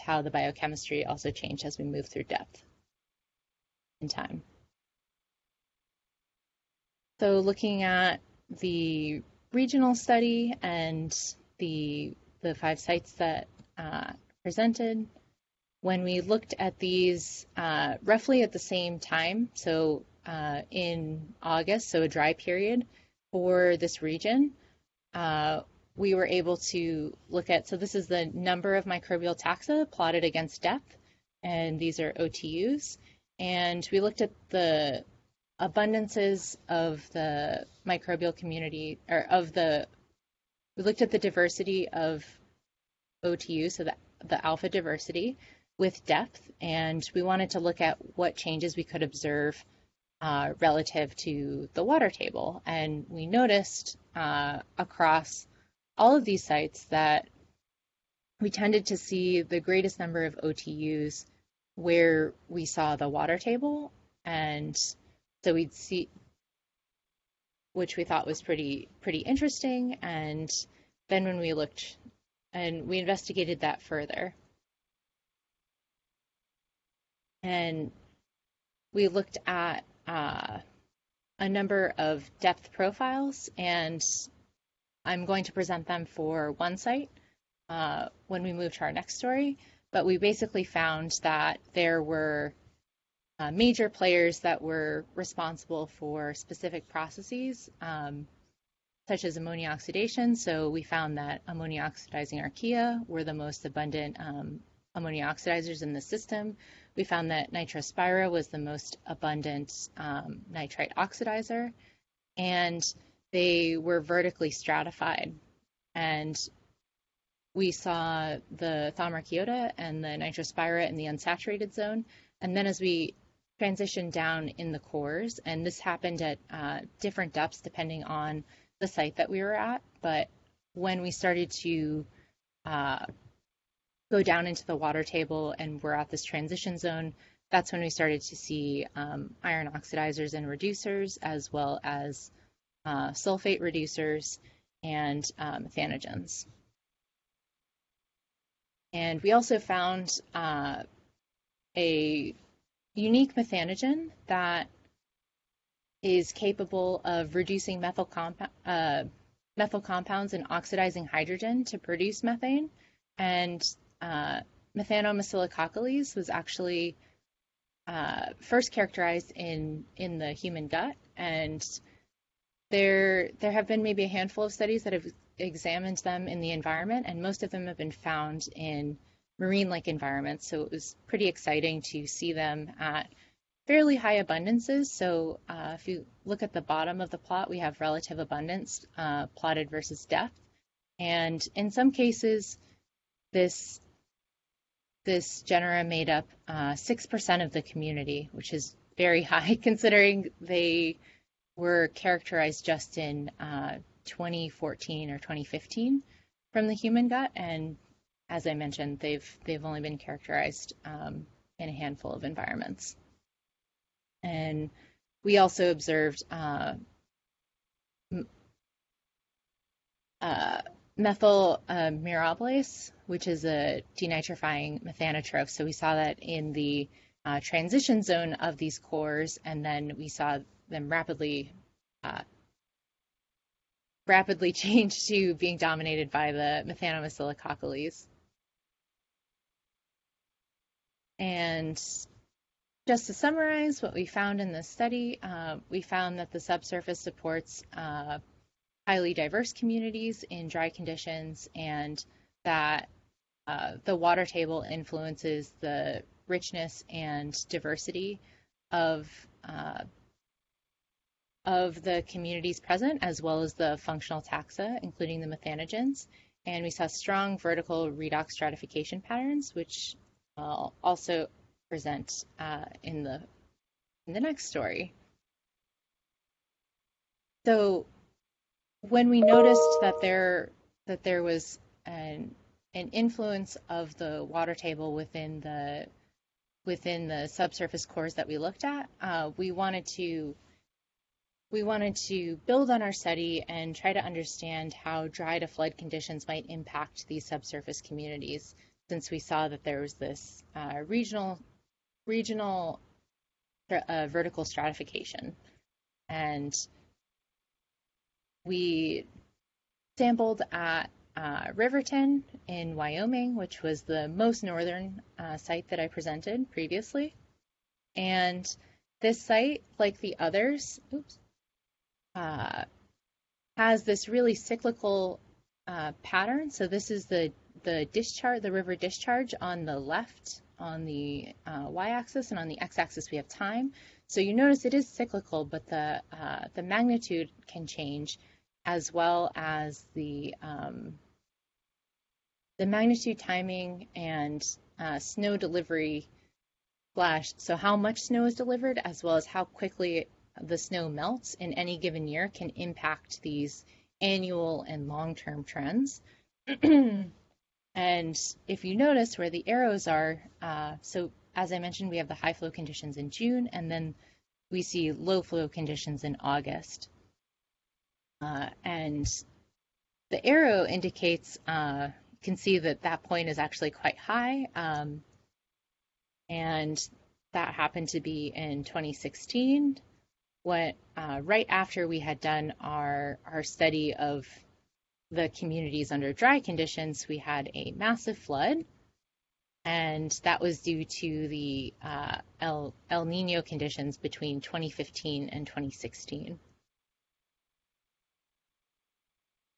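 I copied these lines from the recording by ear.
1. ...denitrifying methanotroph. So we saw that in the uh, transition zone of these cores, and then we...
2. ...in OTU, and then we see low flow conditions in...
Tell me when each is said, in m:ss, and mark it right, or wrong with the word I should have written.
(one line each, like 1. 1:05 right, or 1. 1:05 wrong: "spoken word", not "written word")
1. 3:43 right
2. 6:02 wrong: "June", not "OTU".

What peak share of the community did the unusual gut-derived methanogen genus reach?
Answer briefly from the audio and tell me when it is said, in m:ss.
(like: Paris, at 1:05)
6 percent, at 3:16.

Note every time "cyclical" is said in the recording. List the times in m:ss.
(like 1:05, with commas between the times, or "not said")
5:24, 5:34.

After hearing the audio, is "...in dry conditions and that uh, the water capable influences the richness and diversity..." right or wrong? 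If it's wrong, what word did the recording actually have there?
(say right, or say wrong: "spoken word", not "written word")
wrong: "table", not "capable".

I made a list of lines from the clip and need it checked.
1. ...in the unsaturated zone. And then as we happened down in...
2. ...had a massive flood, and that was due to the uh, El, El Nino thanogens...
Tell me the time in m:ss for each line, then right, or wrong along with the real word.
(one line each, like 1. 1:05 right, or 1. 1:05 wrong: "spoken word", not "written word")
1. 2:00 wrong: "transitioned", not "happened"
2. 6:27 wrong: "conditions", not "thanogens".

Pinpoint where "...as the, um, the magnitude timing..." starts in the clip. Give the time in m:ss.
5:39.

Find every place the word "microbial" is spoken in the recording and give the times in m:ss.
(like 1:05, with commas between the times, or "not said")
0:28, 0:37.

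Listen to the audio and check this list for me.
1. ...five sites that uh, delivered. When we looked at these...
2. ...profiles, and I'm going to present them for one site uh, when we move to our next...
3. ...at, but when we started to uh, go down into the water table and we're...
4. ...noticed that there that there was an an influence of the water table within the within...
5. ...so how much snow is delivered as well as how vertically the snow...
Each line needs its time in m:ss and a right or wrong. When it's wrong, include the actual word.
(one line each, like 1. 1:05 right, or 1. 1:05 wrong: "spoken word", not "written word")
1. 0:12 wrong: "presented", not "delivered"
2. 1:22 right
3. 2:09 right
4. 4:39 right
5. 5:47 wrong: "quickly", not "vertically".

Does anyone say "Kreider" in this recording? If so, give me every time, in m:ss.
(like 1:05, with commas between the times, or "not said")
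not said.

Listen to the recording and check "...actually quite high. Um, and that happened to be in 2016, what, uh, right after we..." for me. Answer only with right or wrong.
right.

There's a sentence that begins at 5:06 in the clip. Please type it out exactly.
And we sampled at uh, Riverton in Wyoming, which was the most northern uh, site that I presented previously.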